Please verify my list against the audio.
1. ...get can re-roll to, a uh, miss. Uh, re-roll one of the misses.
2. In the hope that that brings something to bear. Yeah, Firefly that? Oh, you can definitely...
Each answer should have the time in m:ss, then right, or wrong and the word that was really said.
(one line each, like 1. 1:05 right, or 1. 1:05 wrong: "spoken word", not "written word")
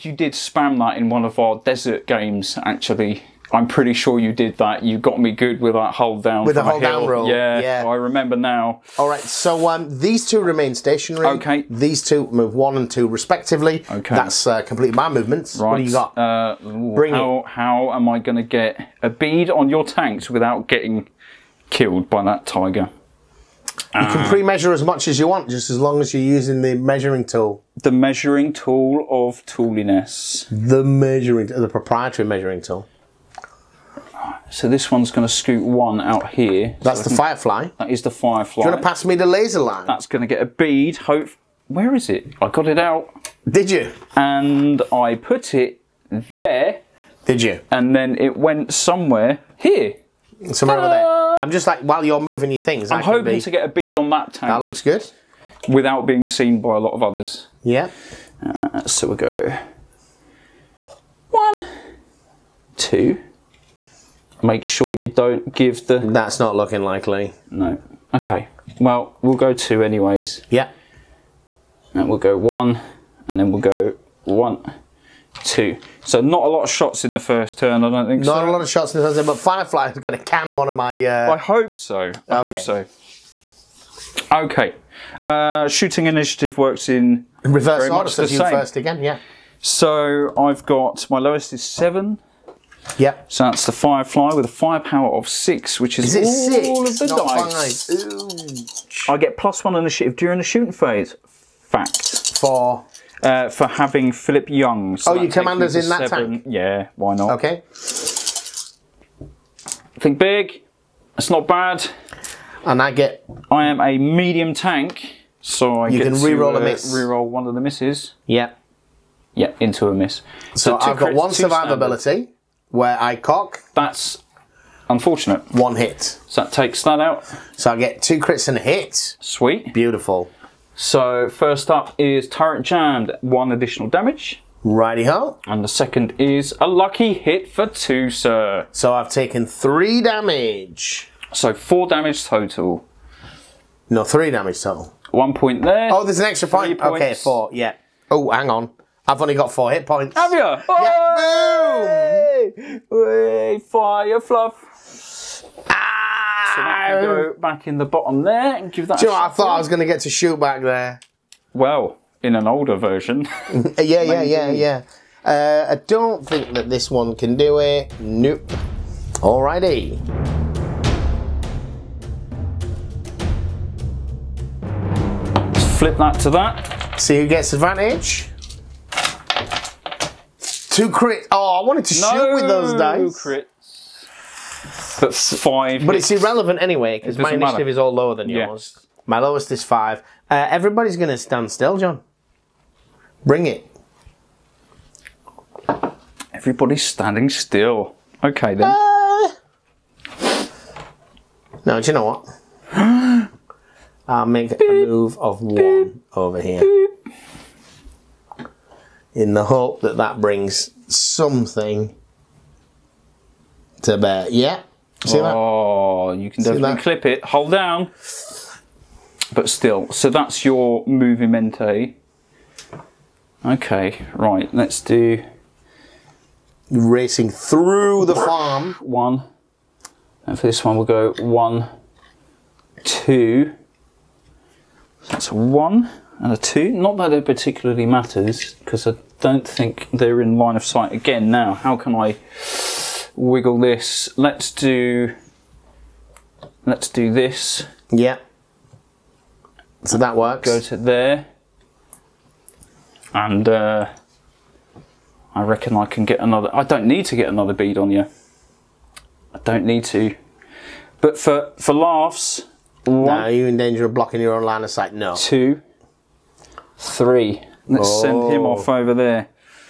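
1. 1:55 right
2. 3:29 wrong: "See", not "Firefly".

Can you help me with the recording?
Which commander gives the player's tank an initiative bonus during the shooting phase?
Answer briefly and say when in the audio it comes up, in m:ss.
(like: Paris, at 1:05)
Philip Young, at 1:44.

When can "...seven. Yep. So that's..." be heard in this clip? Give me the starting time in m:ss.
1:31.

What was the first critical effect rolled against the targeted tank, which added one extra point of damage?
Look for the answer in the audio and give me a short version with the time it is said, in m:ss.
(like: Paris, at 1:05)
Turret Jammed, at 2:12.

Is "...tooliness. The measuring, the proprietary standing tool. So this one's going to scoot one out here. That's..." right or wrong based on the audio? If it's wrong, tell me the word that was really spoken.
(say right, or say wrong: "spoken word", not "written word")
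wrong: "measuring", not "standing".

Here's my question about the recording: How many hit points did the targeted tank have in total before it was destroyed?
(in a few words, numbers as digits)
4.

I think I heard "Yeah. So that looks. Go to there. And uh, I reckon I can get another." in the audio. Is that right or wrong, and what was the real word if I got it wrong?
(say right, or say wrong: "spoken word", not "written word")
wrong: "works", not "looks".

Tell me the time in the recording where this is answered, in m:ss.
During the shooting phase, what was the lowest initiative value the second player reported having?
3:09.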